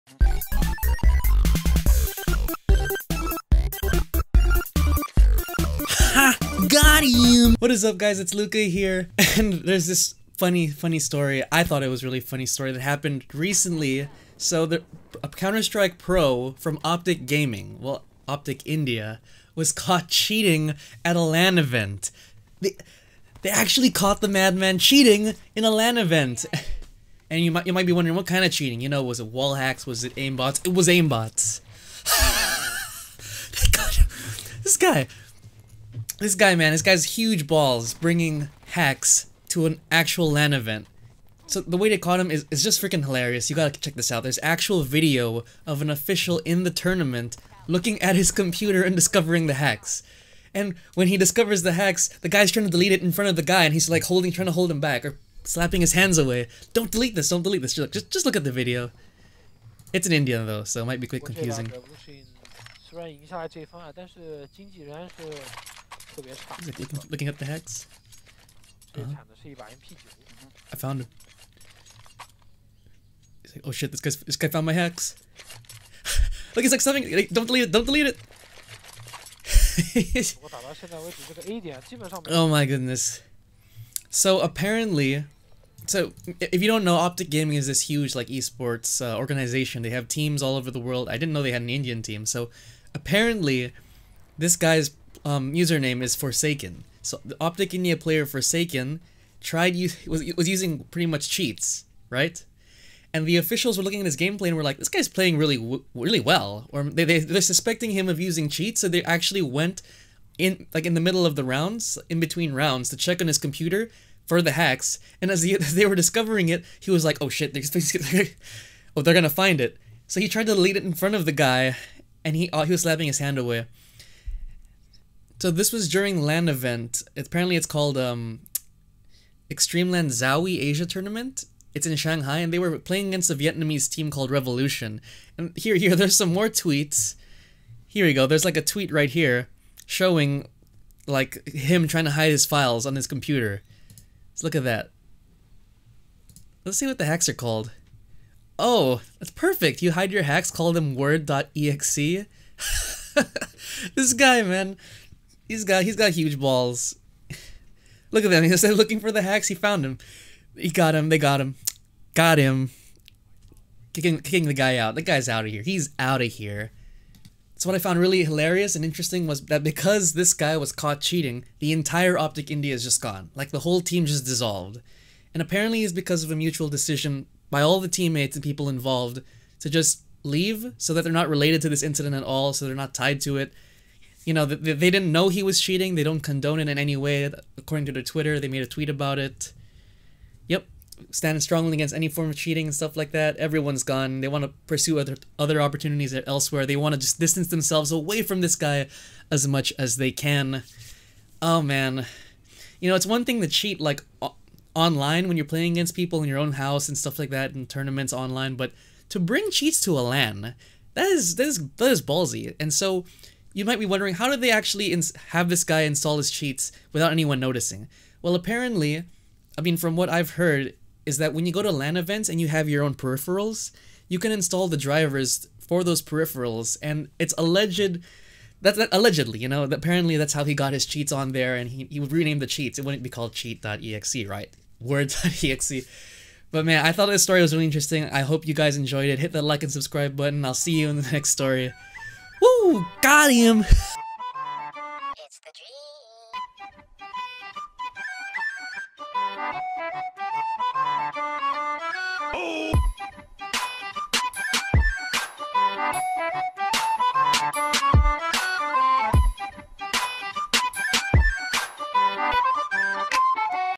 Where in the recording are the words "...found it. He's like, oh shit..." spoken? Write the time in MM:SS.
01:10.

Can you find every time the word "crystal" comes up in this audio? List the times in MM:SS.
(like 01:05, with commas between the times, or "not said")
not said.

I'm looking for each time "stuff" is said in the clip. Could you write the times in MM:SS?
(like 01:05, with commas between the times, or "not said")
03:12, 03:26.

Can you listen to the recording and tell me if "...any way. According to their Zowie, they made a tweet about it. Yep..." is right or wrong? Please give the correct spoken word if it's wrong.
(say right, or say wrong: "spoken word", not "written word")
wrong: "Twitter", not "Zowie".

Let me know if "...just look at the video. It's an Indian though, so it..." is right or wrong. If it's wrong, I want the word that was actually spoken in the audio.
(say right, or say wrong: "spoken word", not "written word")
right.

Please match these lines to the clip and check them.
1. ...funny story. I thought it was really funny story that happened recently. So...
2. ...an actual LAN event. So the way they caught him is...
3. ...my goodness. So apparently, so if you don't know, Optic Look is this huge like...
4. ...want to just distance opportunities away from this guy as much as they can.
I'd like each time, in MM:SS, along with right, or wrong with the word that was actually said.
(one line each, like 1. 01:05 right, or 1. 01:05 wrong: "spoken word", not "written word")
1. 00:10 right
2. 00:39 right
3. 01:22 wrong: "Gaming", not "Look"
4. 03:16 wrong: "themselves", not "opportunities".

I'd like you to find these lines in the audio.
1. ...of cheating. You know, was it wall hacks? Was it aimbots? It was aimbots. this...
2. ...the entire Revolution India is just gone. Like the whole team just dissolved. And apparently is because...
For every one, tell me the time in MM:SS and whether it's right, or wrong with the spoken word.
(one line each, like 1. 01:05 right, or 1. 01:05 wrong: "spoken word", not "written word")
1. 00:28 right
2. 02:51 wrong: "Optic", not "Revolution".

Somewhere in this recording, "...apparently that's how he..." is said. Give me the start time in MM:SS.
03:49.